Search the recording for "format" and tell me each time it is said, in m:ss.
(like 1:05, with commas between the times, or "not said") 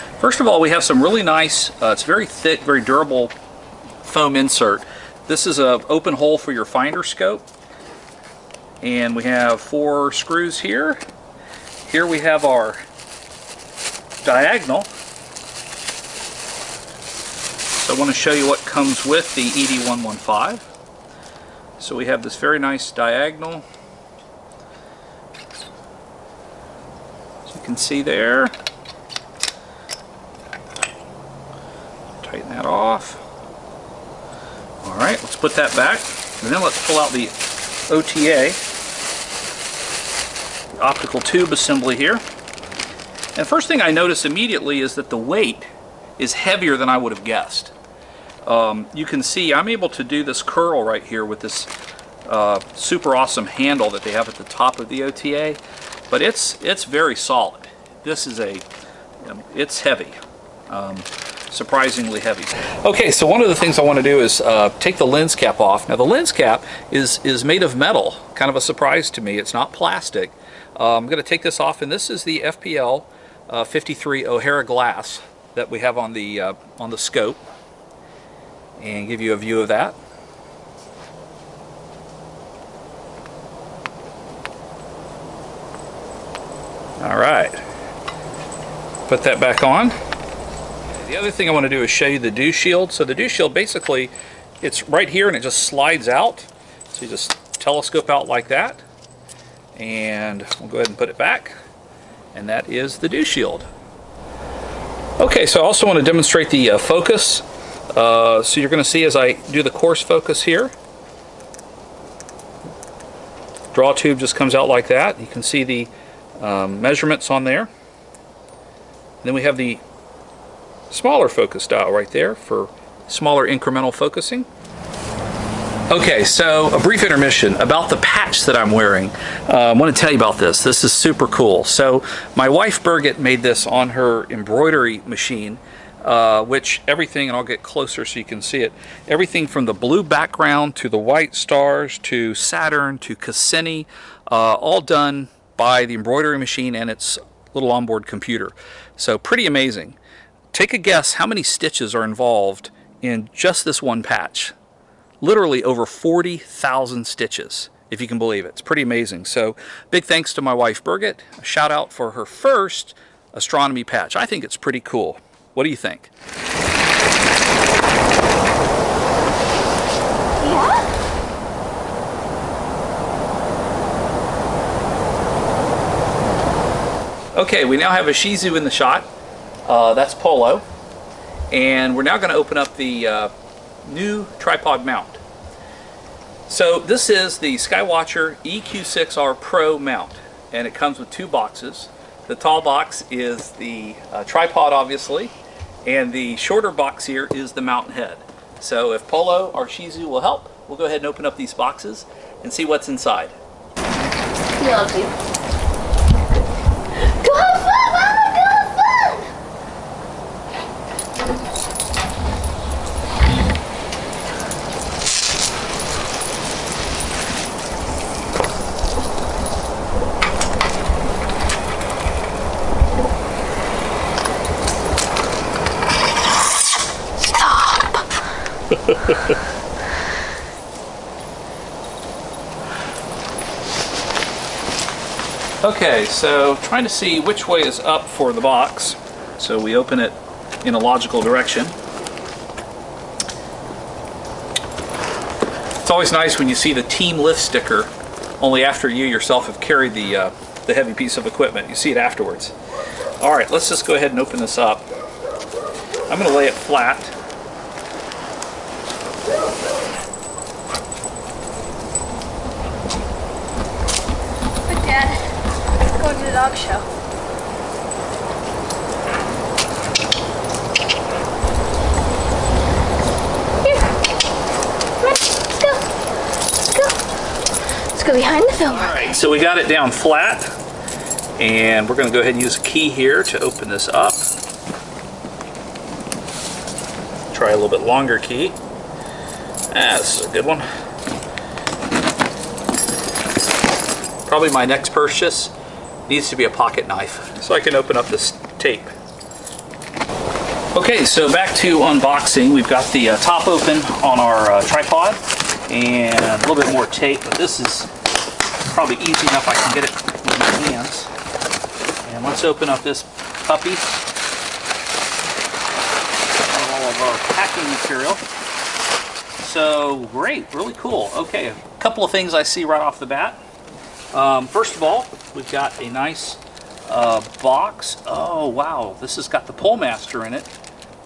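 not said.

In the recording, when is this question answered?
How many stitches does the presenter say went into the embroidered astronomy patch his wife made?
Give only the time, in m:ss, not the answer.
2:35.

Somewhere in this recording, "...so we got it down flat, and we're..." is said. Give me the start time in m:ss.
4:39.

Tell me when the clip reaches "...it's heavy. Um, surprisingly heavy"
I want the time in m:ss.
0:59.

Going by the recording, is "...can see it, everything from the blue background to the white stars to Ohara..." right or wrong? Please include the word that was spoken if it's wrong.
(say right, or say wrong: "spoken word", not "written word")
wrong: "Saturn", not "Ohara".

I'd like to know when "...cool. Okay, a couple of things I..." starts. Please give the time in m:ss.
5:20.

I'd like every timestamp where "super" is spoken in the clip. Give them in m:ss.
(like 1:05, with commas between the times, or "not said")
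0:52, 2:10.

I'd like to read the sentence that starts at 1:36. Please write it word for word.
So you just telescope out like that.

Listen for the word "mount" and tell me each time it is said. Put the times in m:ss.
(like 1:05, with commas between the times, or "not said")
3:04, 3:09, 3:17.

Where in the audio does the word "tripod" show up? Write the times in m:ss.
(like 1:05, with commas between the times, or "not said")
3:04, 3:14, 5:04.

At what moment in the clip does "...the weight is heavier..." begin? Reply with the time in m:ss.
0:45.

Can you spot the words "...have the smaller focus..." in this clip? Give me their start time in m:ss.
1:59.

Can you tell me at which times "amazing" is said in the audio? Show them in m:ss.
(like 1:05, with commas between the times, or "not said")
2:29, 2:38.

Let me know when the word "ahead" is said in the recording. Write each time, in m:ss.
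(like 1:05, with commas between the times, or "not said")
1:40, 3:20, 4:13, 4:42.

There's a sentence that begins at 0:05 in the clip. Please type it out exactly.
This is an open hole for your finder scope and we have four screws here.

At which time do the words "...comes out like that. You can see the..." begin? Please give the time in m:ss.
1:54.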